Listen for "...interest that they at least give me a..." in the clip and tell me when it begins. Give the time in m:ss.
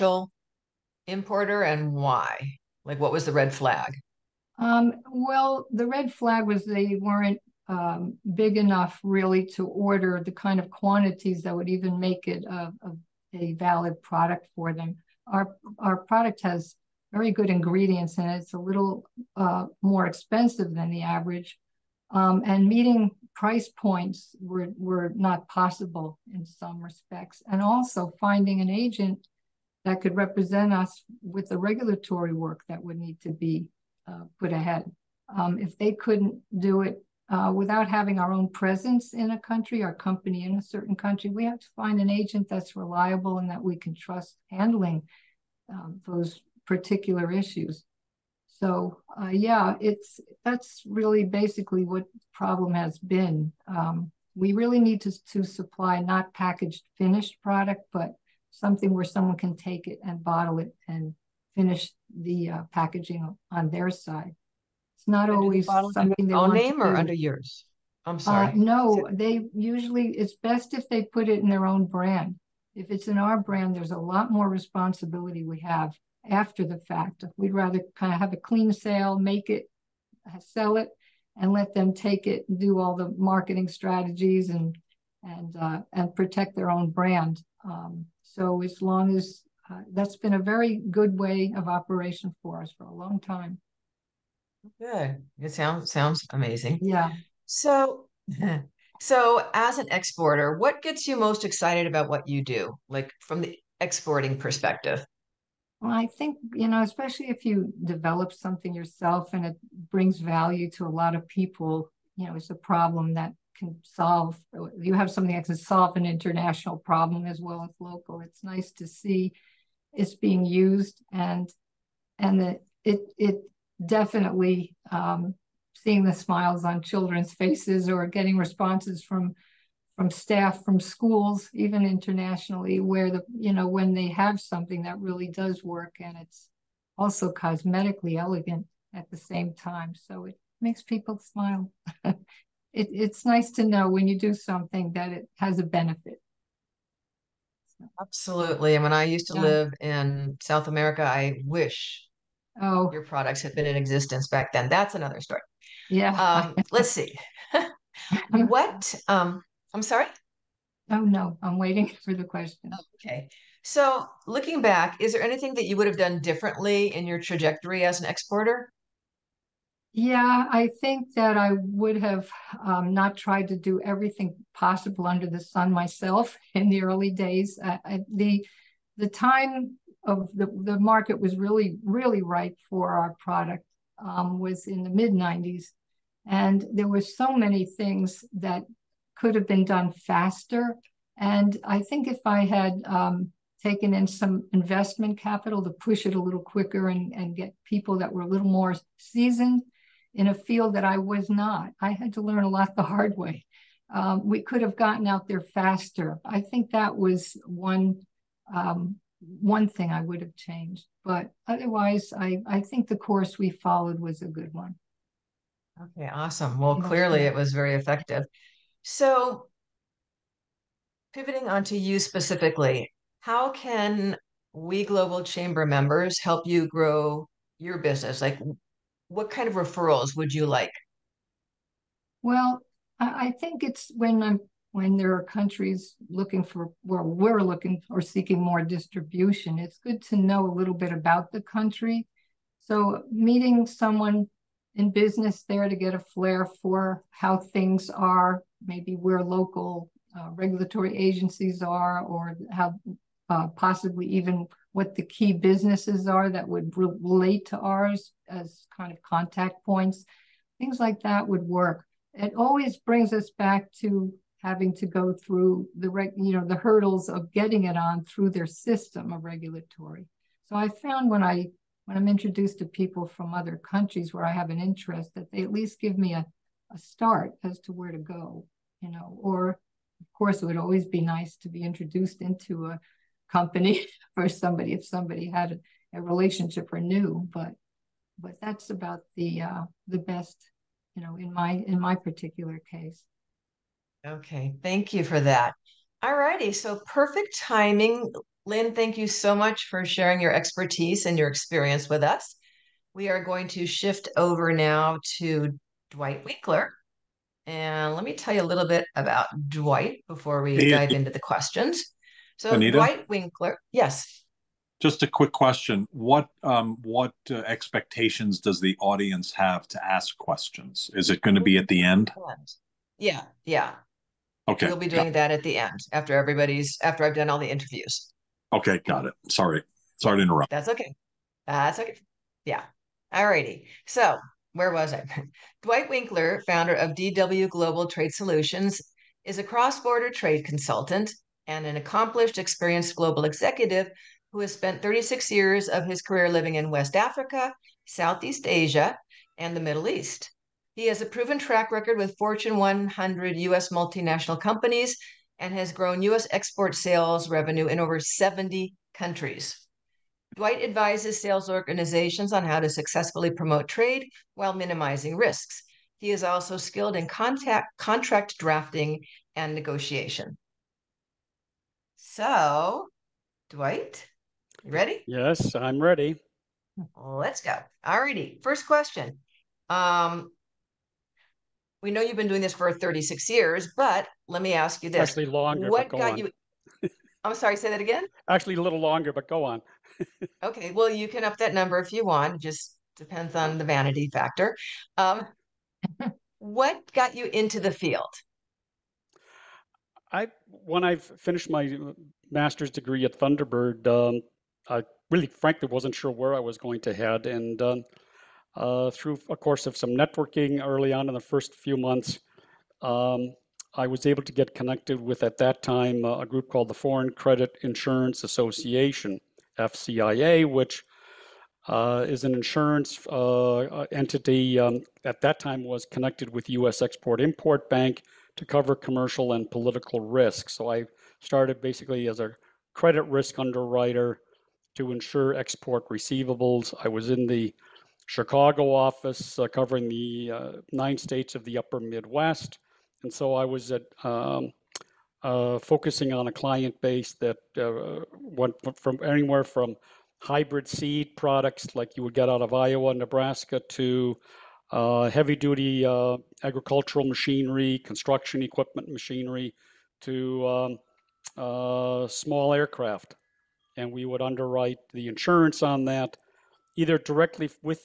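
4:34.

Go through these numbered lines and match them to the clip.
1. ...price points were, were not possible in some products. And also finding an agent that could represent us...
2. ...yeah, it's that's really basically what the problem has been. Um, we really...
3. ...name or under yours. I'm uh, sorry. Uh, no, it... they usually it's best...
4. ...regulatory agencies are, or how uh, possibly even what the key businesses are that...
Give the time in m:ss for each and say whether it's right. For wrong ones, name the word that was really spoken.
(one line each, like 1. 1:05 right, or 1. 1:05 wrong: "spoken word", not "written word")
1. 0:23 wrong: "respects", not "products"
2. 0:49 right
3. 1:06 right
4. 4:10 right.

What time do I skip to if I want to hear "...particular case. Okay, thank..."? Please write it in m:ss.
4:51.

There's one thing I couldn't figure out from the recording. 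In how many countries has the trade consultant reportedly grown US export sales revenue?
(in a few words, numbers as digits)
70.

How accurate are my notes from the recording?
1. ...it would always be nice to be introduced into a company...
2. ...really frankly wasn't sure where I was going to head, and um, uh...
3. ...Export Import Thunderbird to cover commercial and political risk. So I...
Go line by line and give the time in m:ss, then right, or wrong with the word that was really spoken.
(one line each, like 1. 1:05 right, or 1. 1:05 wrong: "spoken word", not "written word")
1. 4:40 right
2. 6:45 right
3. 7:06 wrong: "Bank", not "Thunderbird".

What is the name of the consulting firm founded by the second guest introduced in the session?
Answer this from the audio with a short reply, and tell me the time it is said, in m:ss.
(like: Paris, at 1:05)
DW Global Trade Solutions, at 5:36.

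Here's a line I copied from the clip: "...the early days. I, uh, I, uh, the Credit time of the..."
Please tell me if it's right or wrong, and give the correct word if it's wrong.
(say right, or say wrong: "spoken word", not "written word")
wrong: "The", not "Credit".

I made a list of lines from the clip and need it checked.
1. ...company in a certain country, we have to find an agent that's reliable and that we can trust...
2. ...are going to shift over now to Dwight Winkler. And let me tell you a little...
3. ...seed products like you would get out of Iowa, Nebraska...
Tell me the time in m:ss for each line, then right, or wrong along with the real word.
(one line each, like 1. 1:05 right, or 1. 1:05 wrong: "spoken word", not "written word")
1. 0:39 right
2. 5:03 right
3. 7:30 right.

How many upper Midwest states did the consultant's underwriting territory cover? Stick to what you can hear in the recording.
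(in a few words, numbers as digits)
9.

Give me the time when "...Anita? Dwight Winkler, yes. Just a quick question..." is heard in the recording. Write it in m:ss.
5:12.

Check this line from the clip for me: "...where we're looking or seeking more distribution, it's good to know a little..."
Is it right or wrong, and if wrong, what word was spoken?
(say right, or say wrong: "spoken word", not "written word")
right.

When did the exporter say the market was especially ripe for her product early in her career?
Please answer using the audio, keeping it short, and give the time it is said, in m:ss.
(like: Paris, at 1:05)
mid '90s, at 3:04.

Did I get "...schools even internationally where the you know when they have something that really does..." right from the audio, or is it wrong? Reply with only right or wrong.
right.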